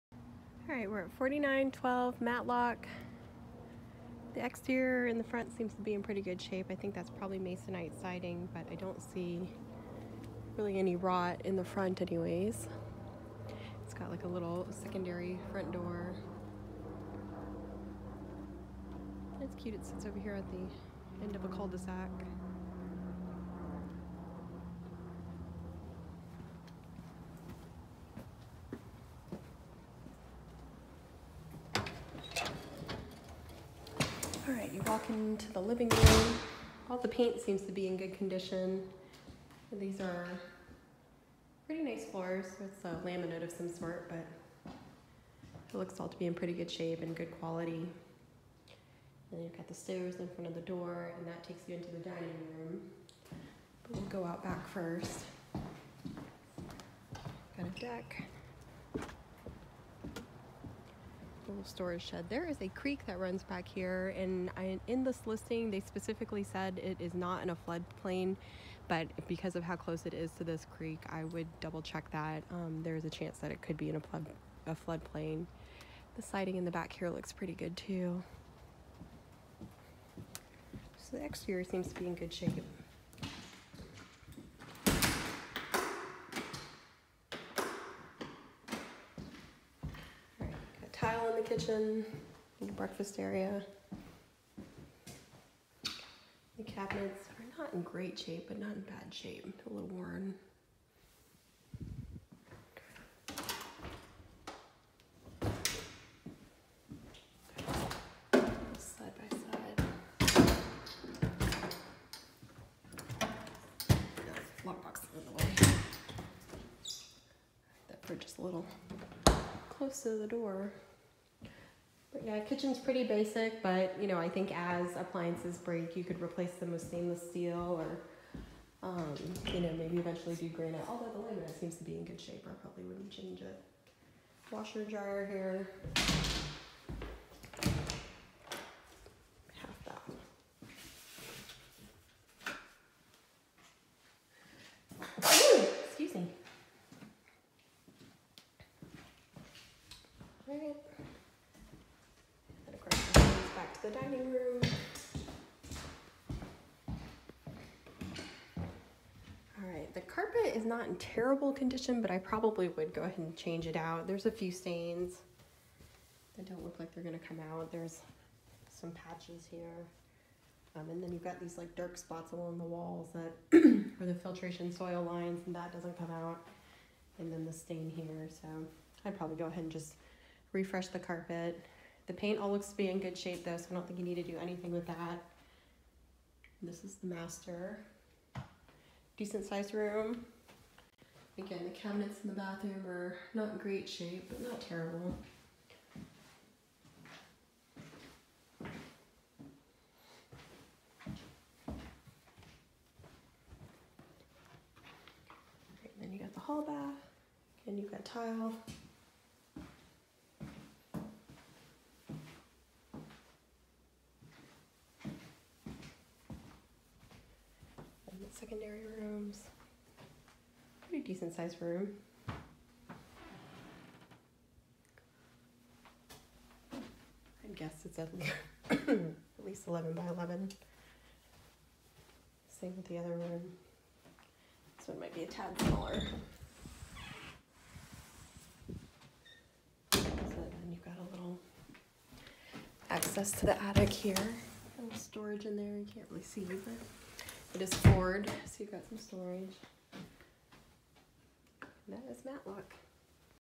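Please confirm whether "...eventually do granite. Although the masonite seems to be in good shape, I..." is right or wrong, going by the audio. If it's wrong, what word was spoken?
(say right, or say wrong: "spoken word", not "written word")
wrong: "laminate", not "masonite".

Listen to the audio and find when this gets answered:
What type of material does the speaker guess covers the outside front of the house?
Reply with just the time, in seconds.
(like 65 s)
7 s.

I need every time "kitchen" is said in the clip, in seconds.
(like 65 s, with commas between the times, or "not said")
91 s, 122 s.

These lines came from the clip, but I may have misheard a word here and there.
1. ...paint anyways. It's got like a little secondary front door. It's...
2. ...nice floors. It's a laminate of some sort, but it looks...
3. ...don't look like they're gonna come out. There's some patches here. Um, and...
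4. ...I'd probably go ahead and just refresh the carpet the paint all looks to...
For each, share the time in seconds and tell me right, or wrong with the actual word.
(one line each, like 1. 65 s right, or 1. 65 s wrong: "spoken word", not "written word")
1. 11 s wrong: "front", not "paint"
2. 41 s right
3. 166 s right
4. 179 s right.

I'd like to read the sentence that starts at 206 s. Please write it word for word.
then you got the hall bath, and you got tile.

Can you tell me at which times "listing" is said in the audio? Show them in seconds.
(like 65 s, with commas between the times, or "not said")
65 s.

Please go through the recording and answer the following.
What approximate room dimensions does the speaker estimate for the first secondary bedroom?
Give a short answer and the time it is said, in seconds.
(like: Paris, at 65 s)
11 by 11, at 229 s.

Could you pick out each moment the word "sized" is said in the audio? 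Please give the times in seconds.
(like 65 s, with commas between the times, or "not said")
189 s, 221 s.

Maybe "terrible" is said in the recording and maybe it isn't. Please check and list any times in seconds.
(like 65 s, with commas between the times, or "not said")
160 s, 194 s.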